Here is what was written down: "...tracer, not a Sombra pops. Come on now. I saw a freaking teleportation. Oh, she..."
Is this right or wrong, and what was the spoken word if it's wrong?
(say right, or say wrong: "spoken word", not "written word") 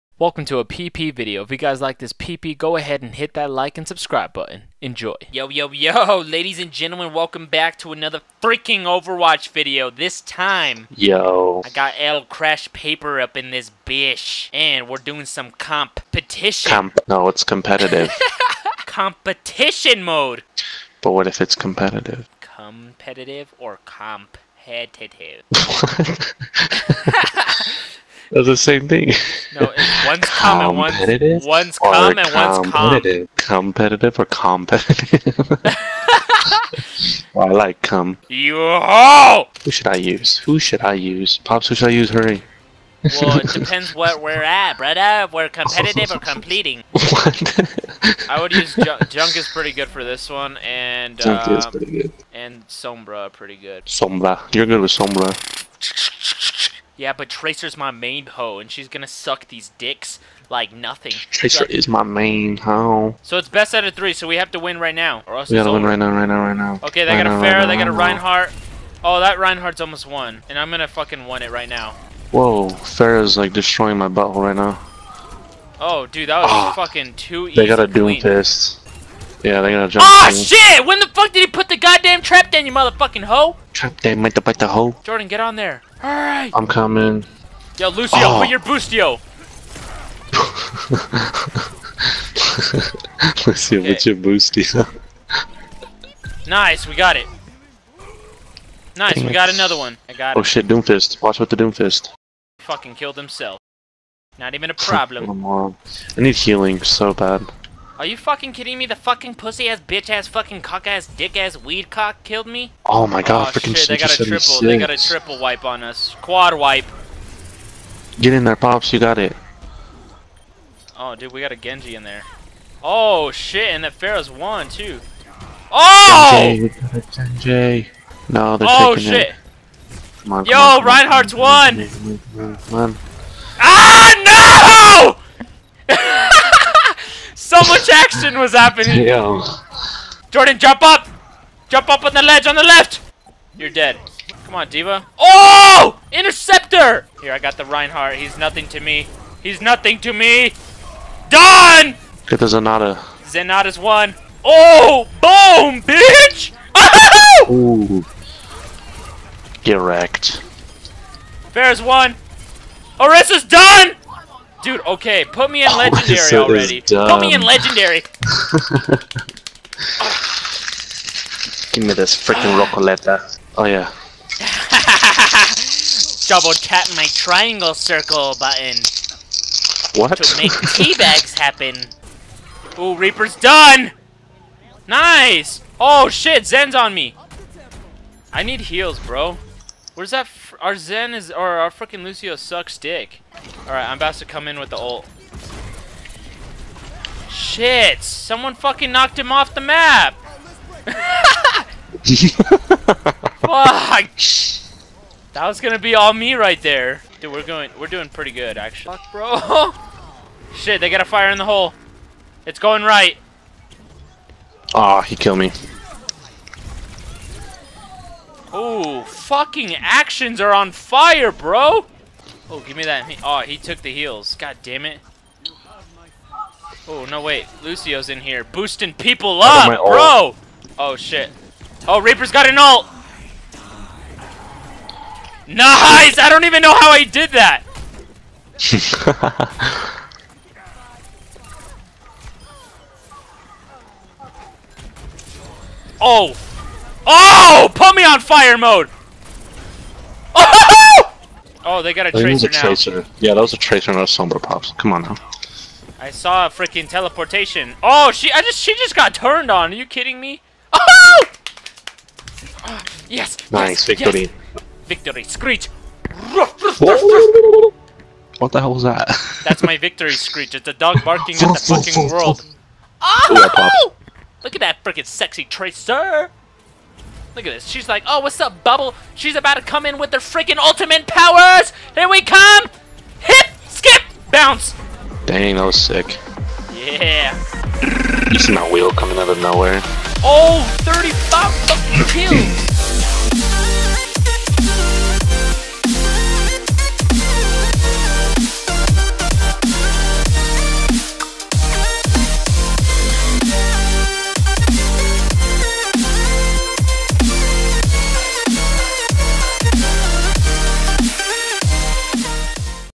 right.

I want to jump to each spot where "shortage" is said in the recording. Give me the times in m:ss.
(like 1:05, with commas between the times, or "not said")
not said.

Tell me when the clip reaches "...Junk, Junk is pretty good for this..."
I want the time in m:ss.
0:48.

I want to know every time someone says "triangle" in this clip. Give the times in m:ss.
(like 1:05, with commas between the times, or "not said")
2:57.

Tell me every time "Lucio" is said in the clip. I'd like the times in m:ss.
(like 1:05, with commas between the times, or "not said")
1:27, 1:33, 3:12, 3:47.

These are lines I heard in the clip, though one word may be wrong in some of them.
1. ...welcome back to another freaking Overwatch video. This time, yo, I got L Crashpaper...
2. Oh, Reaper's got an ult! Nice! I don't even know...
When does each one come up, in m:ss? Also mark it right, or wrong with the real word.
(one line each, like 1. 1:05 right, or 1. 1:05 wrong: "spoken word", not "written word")
1. 0:07 right
2. 3:51 right.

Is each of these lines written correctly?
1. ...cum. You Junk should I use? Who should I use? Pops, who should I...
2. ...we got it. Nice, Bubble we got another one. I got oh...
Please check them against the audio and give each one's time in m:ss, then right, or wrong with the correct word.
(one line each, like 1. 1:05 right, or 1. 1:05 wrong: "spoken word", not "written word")
1. 0:37 wrong: "Who", not "Junk"
2. 1:36 wrong: "Dang", not "Bubble".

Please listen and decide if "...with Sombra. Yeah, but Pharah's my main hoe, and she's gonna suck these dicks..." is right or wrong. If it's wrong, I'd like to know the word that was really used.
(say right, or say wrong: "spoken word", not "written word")
wrong: "Tracer", not "Pharah".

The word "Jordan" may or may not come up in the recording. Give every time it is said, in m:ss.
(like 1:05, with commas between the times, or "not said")
1:25, 2:20.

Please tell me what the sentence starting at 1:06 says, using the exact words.
Okay, they right got a Pharah, right they got a Reinhardt.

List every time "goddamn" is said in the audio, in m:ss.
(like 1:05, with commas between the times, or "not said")
1:21.